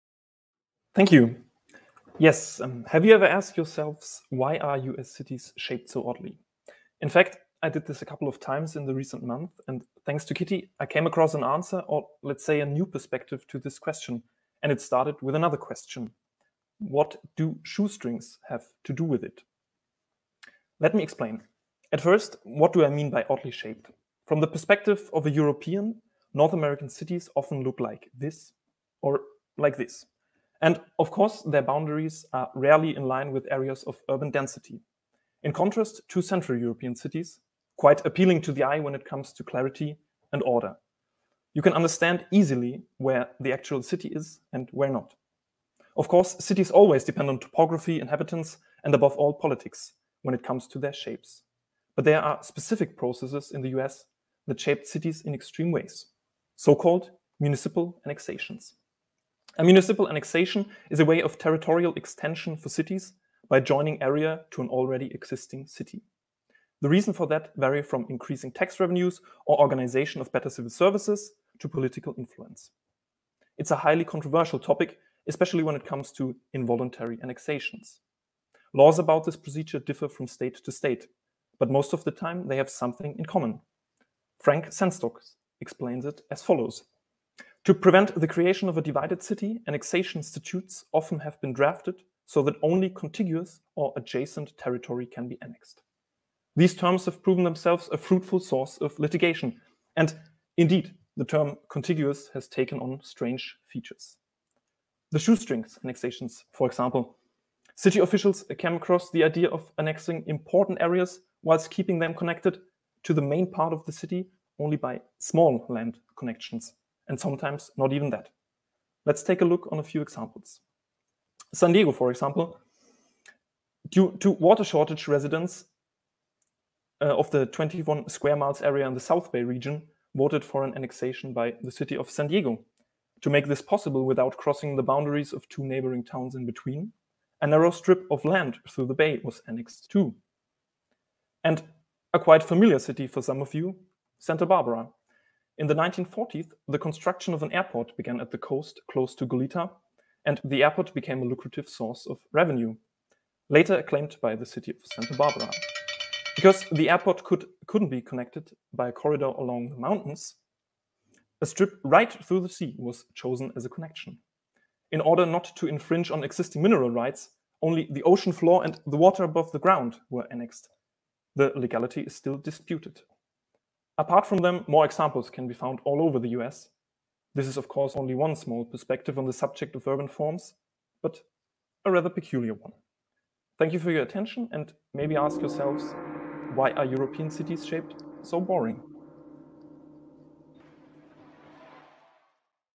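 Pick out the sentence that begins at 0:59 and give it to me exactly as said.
A municipal annexation is a way of territorial extension for cities by joining area to an already existing city.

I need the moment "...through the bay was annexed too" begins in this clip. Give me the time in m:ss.
2:18.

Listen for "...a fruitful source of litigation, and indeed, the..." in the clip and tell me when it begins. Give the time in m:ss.
1:37.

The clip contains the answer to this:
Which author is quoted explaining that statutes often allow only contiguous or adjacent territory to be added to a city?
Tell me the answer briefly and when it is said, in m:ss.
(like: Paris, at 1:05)
Frank Sengstock, at 1:24.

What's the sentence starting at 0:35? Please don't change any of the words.
In contrast to Central European cities, quite appealing to the eye when it comes to clarity and order.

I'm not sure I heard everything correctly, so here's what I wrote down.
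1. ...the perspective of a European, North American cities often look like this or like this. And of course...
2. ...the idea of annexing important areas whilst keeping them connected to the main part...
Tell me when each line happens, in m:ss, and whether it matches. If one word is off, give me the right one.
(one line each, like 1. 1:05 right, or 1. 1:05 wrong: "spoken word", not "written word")
1. 0:24 right
2. 1:49 right.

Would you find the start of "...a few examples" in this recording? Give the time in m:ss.
1:59.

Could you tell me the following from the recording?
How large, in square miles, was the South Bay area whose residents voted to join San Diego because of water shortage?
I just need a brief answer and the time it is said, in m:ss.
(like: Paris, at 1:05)
21 square miles, at 2:07.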